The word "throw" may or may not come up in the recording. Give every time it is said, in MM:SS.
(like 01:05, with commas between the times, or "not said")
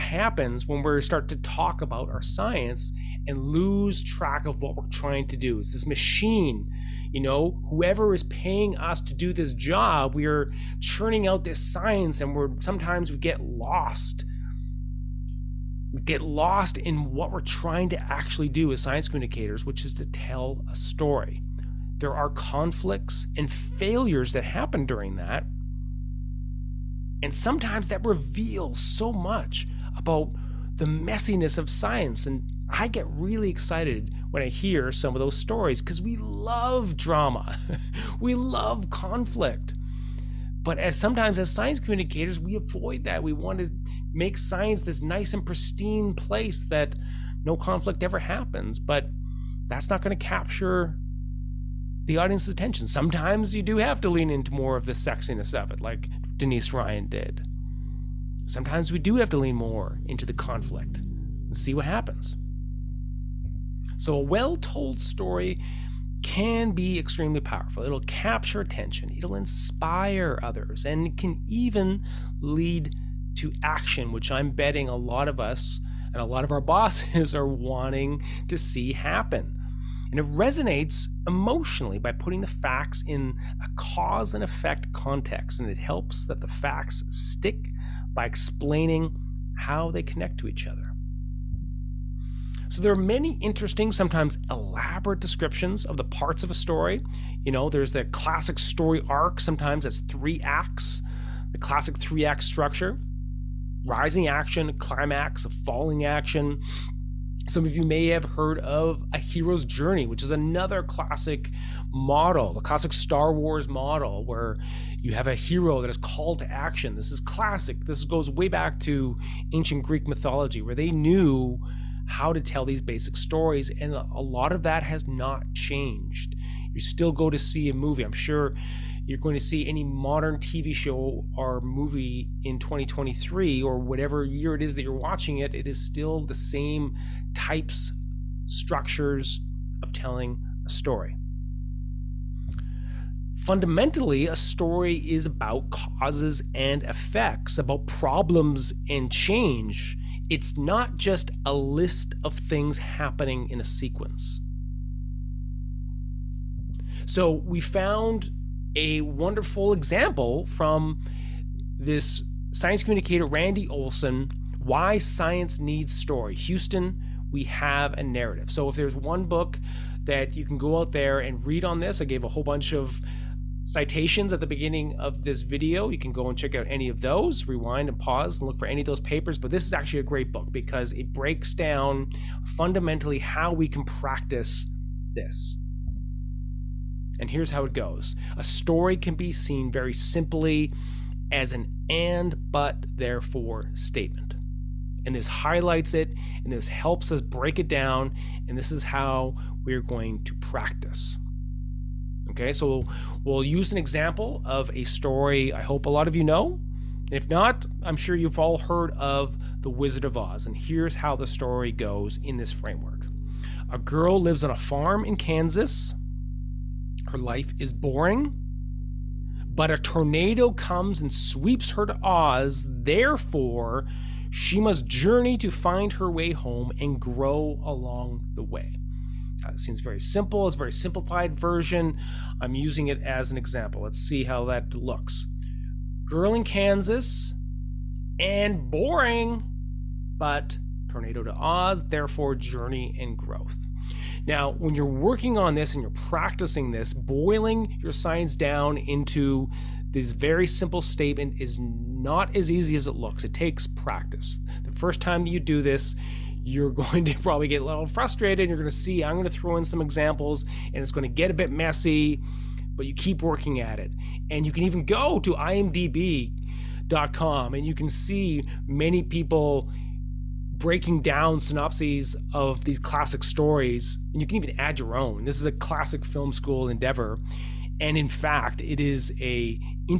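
04:19.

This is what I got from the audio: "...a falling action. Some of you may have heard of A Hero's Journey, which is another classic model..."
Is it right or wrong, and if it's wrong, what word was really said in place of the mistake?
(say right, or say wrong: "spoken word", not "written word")
right.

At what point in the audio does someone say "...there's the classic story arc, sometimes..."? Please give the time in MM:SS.
01:37.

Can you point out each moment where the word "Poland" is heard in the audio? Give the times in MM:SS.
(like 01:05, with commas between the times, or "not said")
not said.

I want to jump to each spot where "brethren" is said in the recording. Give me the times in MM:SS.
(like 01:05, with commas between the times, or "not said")
not said.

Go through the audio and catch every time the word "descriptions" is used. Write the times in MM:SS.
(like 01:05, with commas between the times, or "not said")
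01:35.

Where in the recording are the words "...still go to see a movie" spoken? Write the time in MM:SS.
02:06.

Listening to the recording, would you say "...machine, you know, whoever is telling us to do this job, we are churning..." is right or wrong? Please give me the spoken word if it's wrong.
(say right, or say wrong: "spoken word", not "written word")
wrong: "paying", not "telling".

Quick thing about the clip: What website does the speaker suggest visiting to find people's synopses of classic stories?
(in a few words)
imdb.com.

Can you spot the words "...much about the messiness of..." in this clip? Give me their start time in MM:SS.
00:29.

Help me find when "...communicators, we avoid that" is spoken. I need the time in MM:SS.
00:41.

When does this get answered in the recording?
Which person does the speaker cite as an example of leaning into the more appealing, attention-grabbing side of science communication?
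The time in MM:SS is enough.
00:56.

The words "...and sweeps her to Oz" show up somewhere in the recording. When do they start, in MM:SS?
03:41.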